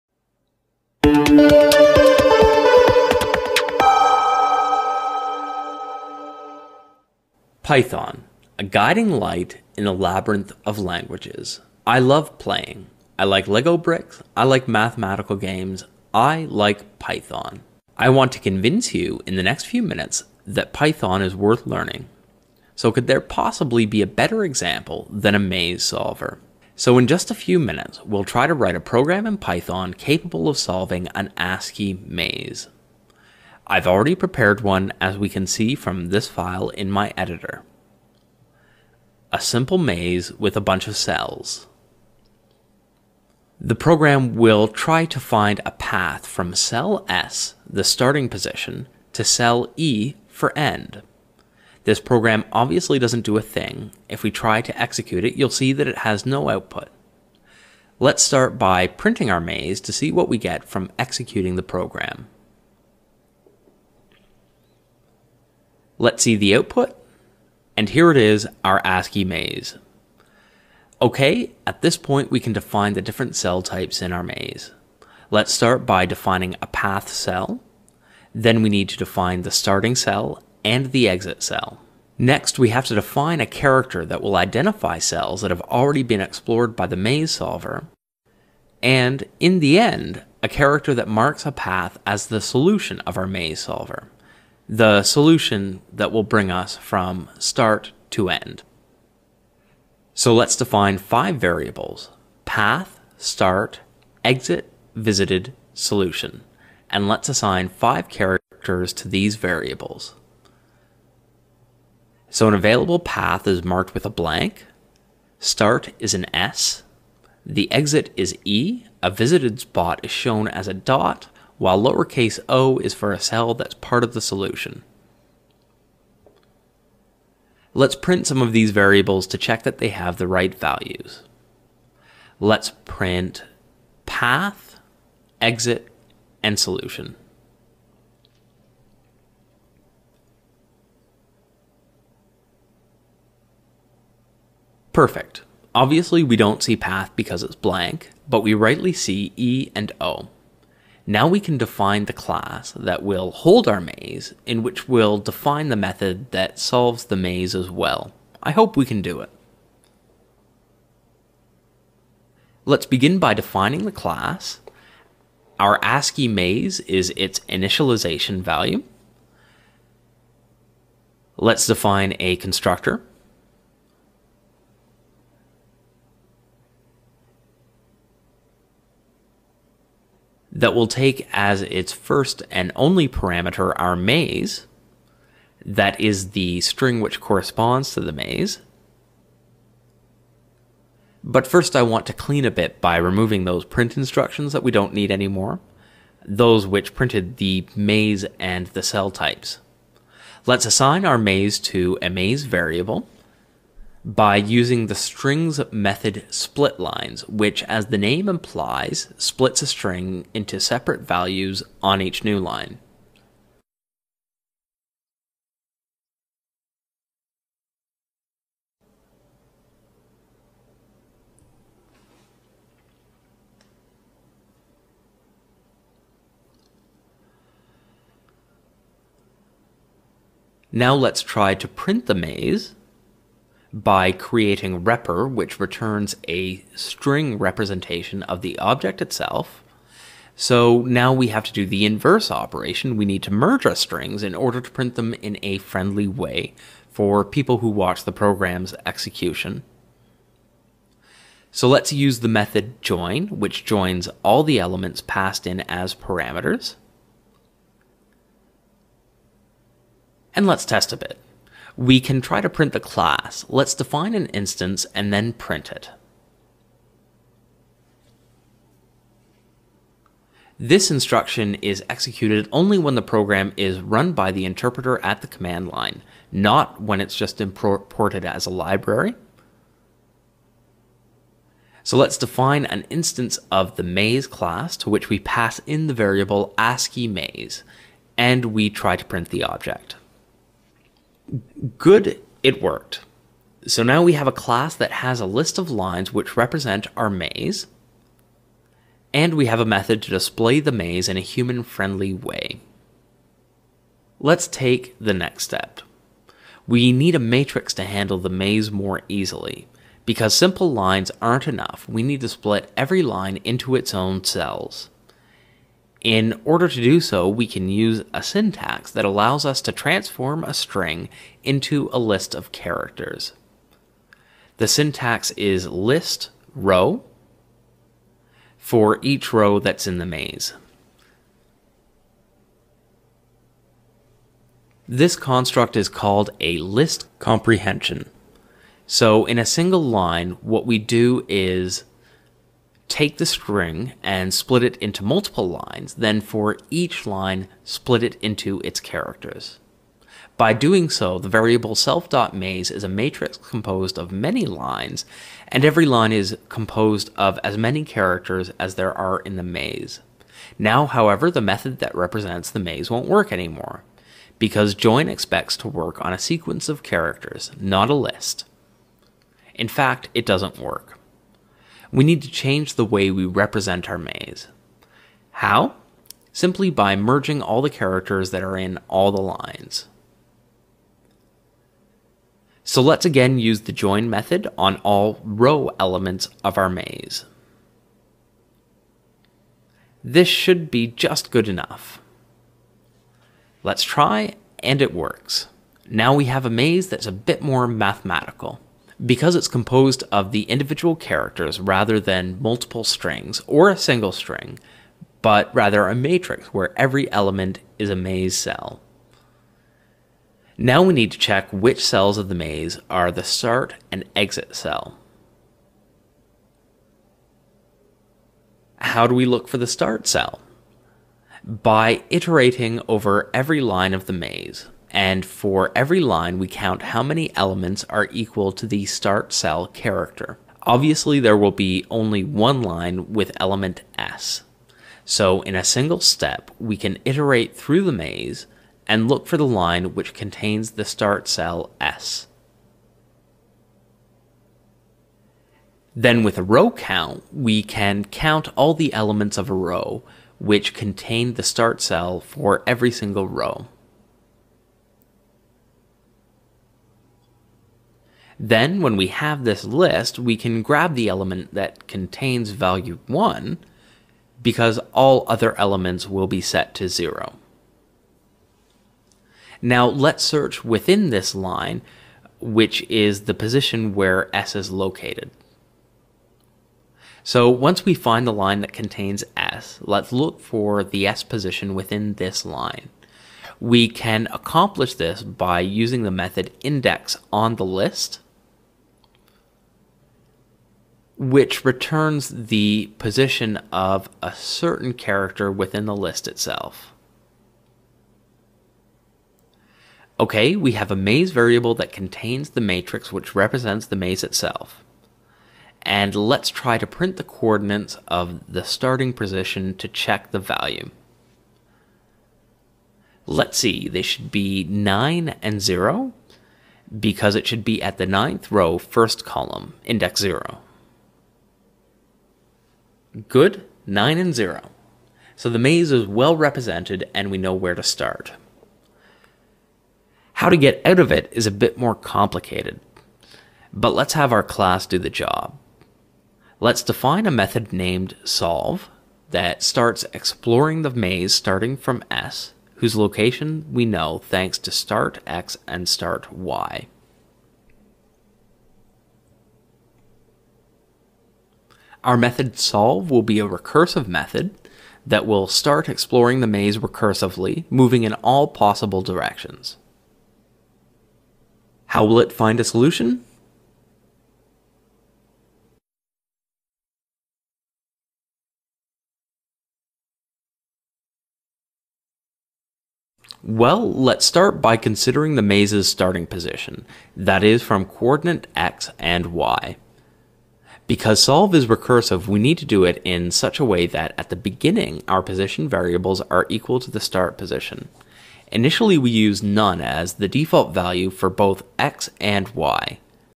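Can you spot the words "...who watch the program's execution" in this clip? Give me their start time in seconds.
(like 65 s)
247 s.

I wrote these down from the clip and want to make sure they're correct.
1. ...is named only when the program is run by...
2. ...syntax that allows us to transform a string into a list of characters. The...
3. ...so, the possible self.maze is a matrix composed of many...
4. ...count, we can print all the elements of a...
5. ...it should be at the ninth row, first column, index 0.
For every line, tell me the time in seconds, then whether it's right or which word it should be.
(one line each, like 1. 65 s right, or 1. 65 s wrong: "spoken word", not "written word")
1. 271 s wrong: "executed", not "named"
2. 318 s right
3. 350 s wrong: "variable", not "possible"
4. 446 s wrong: "count", not "print"
5. 517 s right.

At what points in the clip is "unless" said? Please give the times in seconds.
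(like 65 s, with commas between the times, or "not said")
not said.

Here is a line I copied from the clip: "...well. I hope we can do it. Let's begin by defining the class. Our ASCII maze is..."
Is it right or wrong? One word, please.
right.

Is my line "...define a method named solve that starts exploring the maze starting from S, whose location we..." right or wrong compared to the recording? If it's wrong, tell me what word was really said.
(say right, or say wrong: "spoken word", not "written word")
right.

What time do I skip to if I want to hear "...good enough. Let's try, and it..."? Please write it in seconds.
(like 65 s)
391 s.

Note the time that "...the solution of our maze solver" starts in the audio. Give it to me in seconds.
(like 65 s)
92 s.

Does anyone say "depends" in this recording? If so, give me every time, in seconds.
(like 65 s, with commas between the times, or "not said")
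not said.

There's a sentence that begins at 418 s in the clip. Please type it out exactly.
How do we look for the start cell?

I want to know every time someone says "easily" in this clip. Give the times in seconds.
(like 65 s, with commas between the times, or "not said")
309 s.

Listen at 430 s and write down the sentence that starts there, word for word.
Obviously, there will be only one line with element S.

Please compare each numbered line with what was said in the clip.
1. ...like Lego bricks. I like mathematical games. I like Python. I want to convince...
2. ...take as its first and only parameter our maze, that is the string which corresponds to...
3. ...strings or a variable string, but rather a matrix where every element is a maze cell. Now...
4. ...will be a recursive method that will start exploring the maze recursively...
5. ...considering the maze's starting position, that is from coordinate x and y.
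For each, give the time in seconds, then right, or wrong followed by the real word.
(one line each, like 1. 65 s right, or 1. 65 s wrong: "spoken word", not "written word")
1. 13 s right
2. 180 s right
3. 402 s wrong: "single", not "variable"
4. 553 s right
5. 574 s right.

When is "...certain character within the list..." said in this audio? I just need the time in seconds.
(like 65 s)
494 s.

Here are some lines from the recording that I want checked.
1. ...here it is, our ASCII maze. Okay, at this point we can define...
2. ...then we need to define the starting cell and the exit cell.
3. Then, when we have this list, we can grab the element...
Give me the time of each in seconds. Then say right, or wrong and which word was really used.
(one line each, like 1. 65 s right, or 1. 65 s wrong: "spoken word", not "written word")
1. 67 s right
2. 78 s right
3. 458 s right.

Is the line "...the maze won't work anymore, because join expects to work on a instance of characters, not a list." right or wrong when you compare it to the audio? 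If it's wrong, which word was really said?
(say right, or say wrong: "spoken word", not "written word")
wrong: "sequence", not "instance".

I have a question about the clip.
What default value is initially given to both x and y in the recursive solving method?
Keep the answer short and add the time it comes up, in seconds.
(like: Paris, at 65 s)
None, at 589 s.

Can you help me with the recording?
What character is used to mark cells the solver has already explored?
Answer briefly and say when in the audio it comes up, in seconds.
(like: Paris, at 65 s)
a dot, at 120 s.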